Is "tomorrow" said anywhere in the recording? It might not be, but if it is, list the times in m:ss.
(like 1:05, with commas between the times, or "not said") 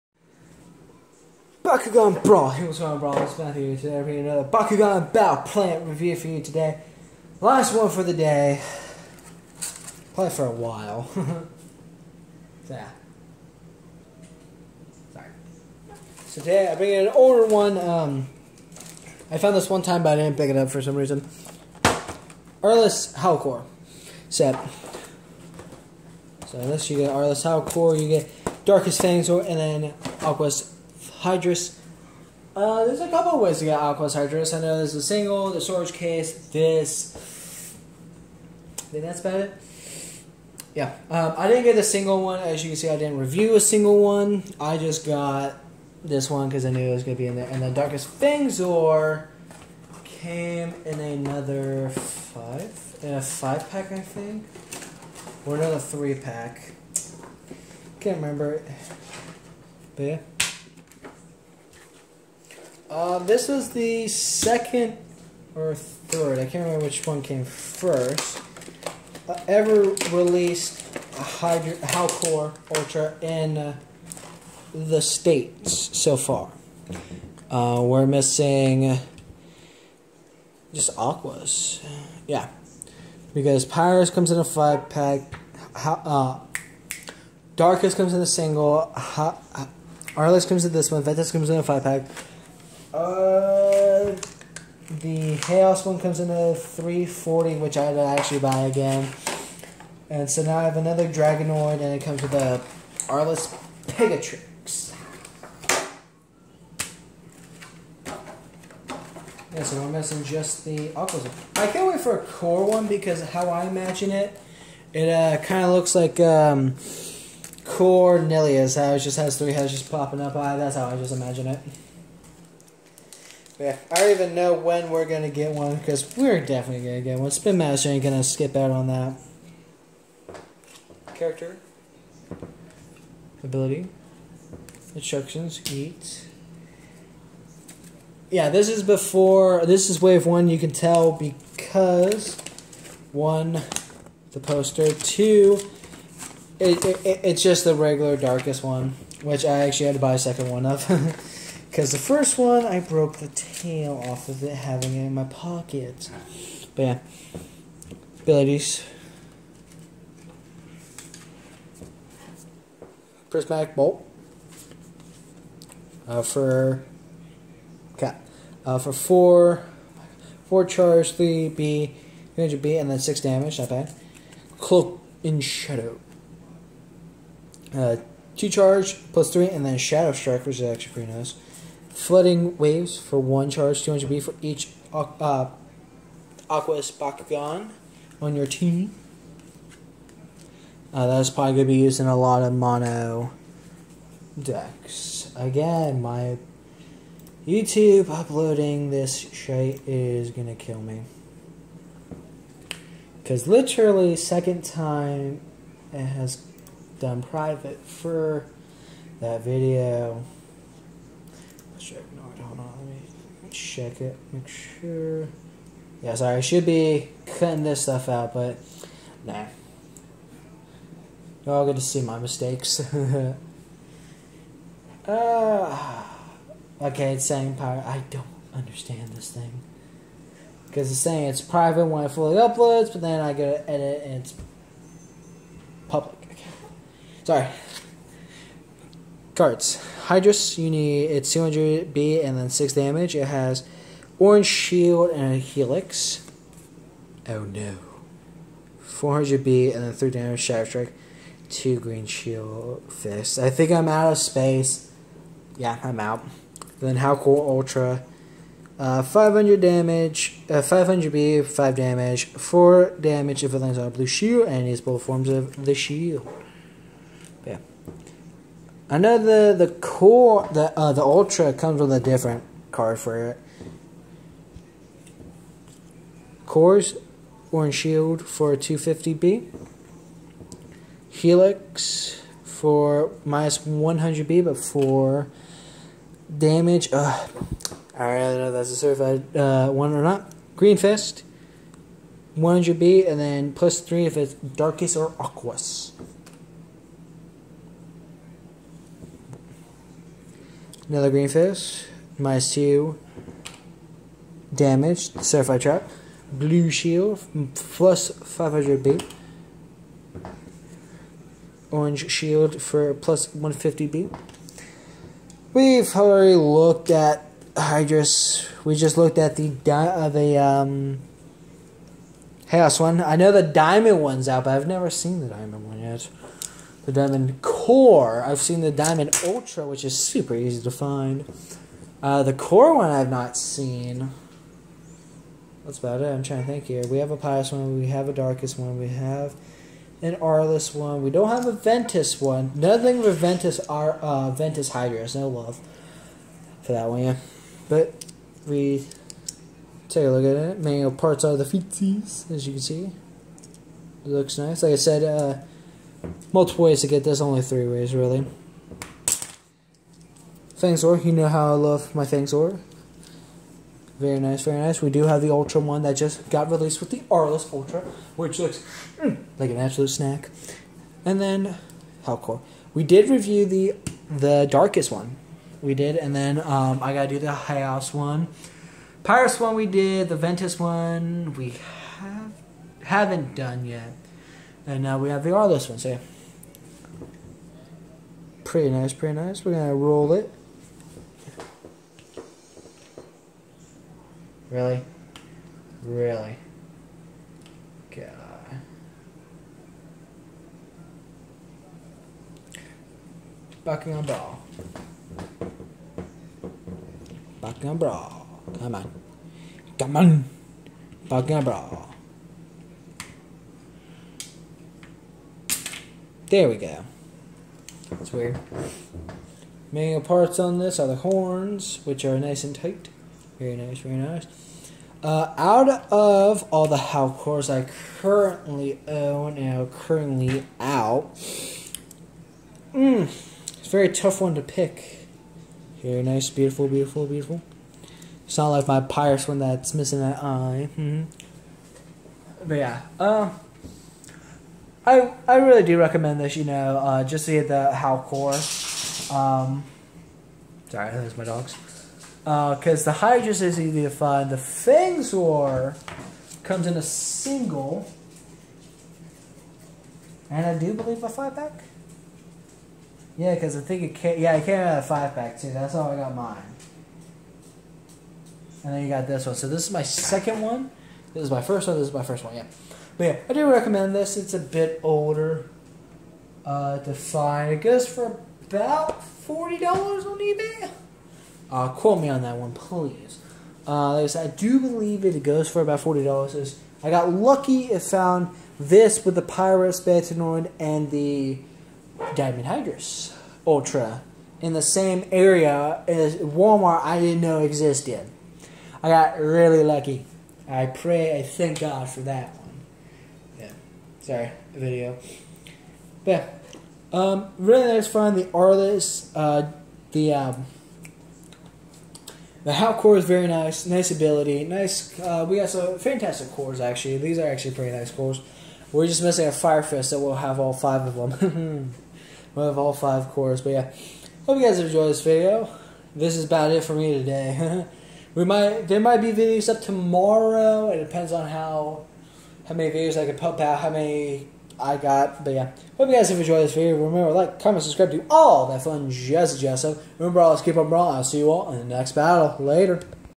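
8:49.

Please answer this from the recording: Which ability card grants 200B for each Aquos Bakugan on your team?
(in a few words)
Flooding Waves.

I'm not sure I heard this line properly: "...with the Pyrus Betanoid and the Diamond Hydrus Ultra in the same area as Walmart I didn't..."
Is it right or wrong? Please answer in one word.
right.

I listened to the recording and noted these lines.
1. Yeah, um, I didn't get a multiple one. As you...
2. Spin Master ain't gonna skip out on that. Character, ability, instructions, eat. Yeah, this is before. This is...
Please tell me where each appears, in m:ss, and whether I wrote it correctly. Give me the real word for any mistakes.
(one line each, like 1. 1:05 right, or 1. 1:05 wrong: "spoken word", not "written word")
1. 0:40 wrong: "single", not "multiple"
2. 2:07 right.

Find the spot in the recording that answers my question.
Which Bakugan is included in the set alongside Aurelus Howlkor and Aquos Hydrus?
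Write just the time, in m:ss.
0:28.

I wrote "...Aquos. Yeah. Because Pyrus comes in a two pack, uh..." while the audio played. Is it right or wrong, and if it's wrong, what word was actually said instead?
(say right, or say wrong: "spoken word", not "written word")
wrong: "five", not "two".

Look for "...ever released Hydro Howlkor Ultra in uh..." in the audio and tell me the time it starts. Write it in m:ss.
1:09.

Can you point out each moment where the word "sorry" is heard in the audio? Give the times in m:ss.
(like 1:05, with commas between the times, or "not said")
0:15, 3:36, 3:57, 7:30, 8:24.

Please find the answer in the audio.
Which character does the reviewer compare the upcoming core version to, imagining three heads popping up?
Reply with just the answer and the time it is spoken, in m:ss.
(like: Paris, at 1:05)
Cornelius, at 1:57.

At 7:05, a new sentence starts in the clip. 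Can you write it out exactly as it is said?
Uh, out of all the Howlkors I currently own now currently out, mm, it's a very tough one to pick.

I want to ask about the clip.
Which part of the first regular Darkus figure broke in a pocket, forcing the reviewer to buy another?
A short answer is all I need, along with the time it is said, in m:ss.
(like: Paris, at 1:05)
The tail, at 2:33.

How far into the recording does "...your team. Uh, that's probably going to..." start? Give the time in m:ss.
3:08.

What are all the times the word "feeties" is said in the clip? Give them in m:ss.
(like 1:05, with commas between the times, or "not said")
5:51.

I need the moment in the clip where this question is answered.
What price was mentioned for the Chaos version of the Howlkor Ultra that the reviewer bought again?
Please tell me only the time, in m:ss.
1:36.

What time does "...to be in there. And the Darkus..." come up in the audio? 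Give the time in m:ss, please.
0:47.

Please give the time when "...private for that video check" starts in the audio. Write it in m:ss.
3:27.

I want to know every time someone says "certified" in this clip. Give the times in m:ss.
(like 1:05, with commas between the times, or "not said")
4:48, 5:05.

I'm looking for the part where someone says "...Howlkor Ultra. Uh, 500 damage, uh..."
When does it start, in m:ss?
4:16.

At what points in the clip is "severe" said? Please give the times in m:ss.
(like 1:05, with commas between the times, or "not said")
not said.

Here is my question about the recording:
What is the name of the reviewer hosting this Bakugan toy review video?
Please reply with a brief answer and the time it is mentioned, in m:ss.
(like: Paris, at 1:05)
Matthew, at 0:03.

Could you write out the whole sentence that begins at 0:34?
I know there's a single, the storage case, this.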